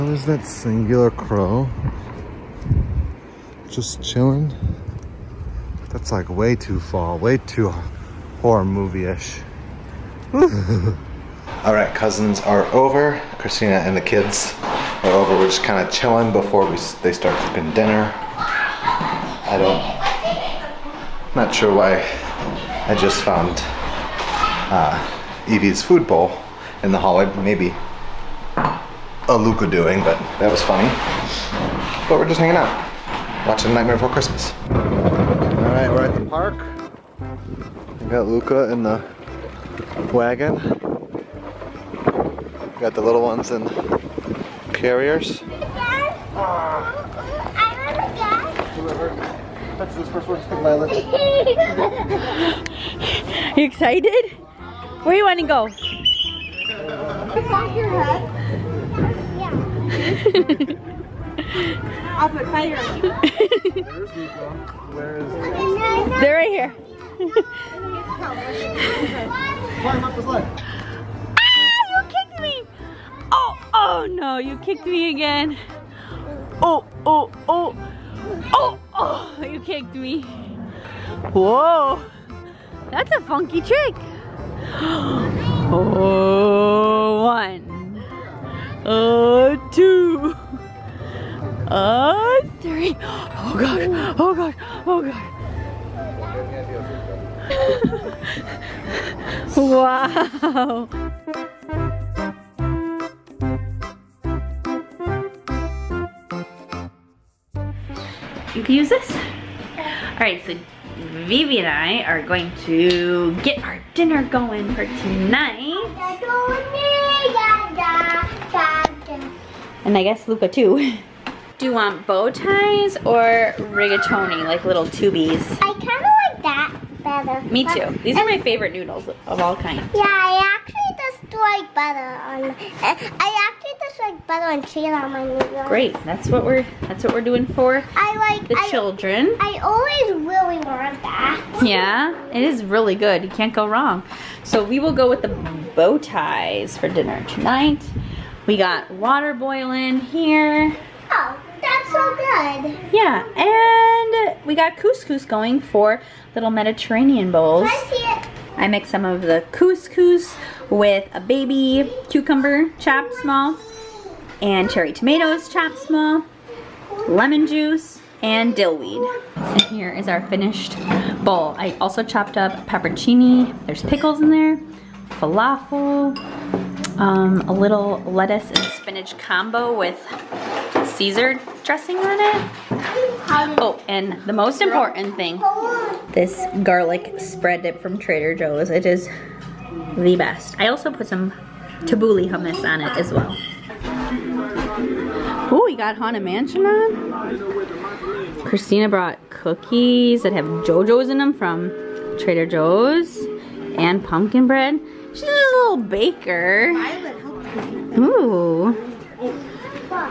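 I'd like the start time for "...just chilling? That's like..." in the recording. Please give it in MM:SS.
00:03.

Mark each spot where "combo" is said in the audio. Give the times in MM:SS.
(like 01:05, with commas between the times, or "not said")
02:59.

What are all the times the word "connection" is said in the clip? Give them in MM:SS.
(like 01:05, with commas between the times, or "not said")
not said.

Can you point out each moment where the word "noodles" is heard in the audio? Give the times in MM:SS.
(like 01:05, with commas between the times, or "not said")
02:08, 02:15.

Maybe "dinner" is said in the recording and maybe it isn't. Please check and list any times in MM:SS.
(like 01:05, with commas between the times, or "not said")
00:17, 01:53, 02:26.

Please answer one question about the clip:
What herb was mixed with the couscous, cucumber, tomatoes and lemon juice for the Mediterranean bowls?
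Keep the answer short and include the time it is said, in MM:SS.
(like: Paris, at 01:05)
dill weed, at 02:48.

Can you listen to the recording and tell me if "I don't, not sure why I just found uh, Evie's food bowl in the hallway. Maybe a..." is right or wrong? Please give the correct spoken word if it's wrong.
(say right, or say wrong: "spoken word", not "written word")
right.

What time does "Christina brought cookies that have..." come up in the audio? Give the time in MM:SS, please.
03:18.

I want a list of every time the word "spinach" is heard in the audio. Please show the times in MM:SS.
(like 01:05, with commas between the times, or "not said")
02:58.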